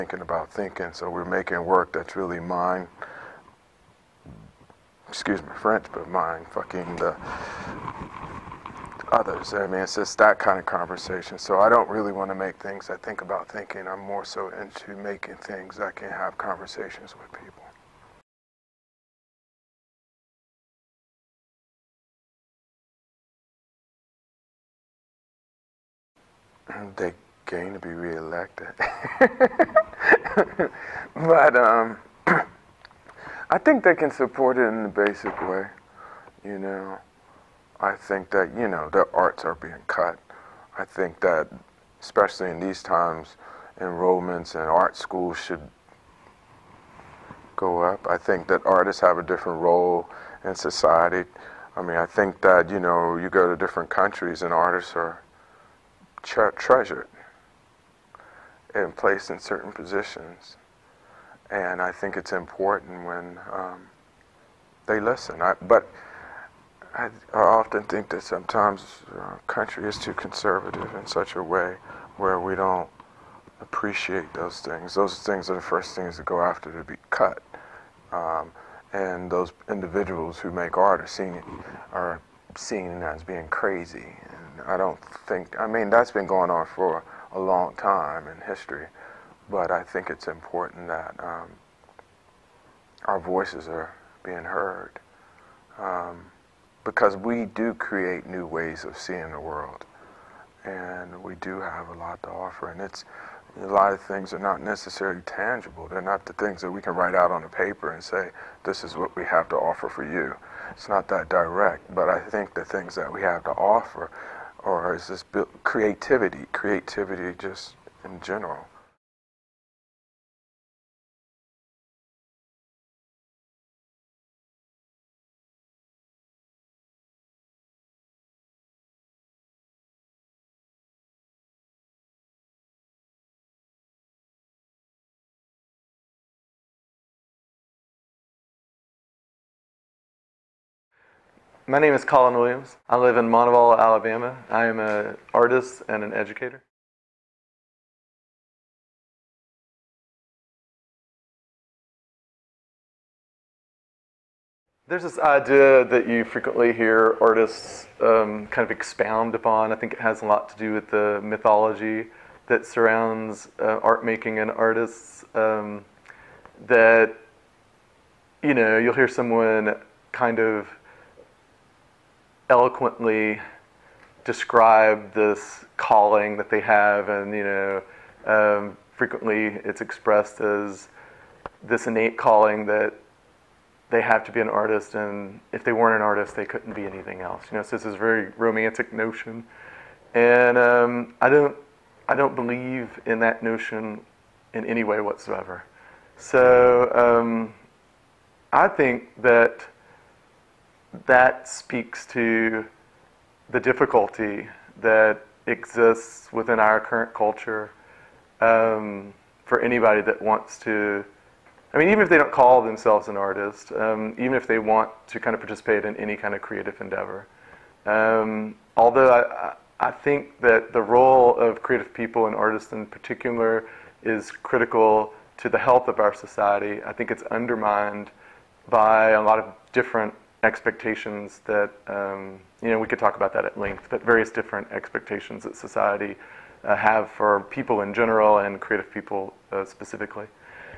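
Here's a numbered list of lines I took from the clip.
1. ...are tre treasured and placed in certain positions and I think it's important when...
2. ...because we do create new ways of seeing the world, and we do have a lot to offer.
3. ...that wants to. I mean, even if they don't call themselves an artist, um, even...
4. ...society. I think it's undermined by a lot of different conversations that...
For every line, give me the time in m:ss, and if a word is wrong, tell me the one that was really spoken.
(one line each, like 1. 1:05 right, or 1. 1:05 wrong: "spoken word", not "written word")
1. 0:54 right
2. 1:36 right
3. 3:30 right
4. 3:46 wrong: "expectations", not "conversations".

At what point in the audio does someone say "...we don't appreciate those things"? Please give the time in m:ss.
1:12.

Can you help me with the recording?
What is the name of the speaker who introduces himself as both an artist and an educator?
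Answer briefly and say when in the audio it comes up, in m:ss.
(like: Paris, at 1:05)
Collin Williams, at 2:22.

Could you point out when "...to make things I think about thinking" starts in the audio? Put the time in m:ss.
0:12.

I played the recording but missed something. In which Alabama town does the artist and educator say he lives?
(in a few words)
Montevallo.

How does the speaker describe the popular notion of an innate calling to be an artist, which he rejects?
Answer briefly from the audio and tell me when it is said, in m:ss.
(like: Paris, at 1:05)
Very romantic, at 3:07.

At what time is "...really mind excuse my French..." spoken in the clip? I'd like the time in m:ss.
0:02.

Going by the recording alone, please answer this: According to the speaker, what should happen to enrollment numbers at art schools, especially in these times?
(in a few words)
Go up.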